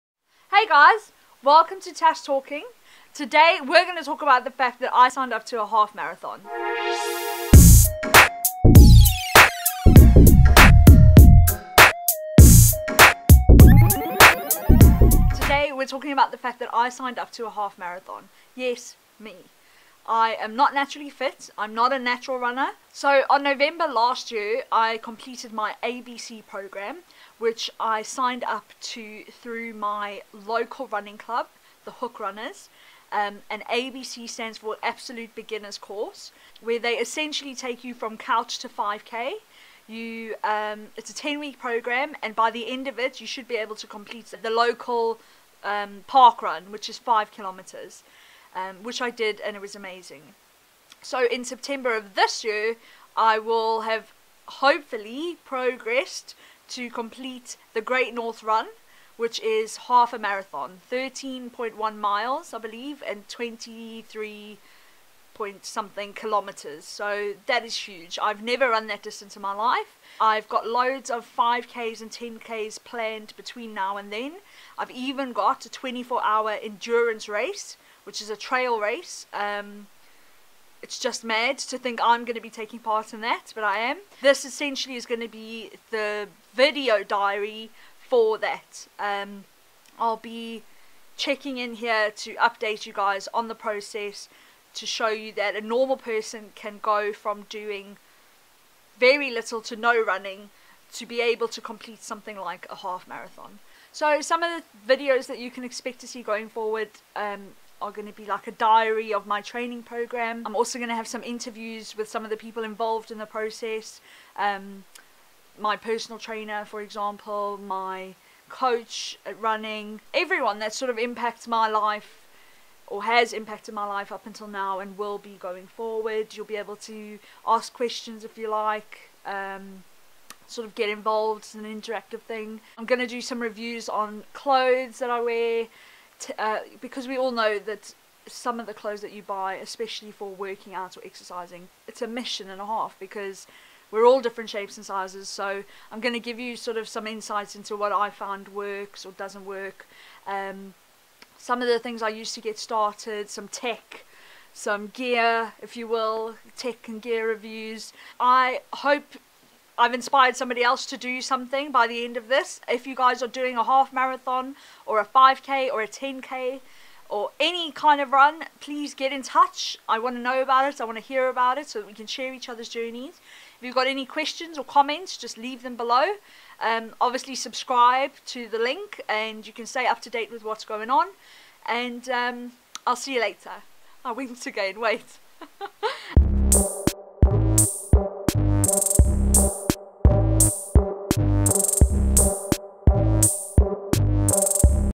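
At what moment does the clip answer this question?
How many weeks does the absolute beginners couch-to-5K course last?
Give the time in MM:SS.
00:41.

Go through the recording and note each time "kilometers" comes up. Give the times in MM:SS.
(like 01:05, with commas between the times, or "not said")
00:47, 01:06.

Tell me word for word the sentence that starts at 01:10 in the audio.
I've got loads of 5Ks and 10Ks planned between now and then.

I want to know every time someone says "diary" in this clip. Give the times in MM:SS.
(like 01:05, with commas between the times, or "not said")
01:27, 01:48.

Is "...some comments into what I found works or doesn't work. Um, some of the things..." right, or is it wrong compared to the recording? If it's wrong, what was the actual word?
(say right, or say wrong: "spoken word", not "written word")
wrong: "insights", not "comments".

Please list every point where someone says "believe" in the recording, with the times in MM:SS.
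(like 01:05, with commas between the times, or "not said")
01:02.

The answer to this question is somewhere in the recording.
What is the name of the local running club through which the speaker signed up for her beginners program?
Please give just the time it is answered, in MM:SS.
00:31.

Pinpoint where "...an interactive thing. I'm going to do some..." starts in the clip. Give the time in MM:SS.
02:11.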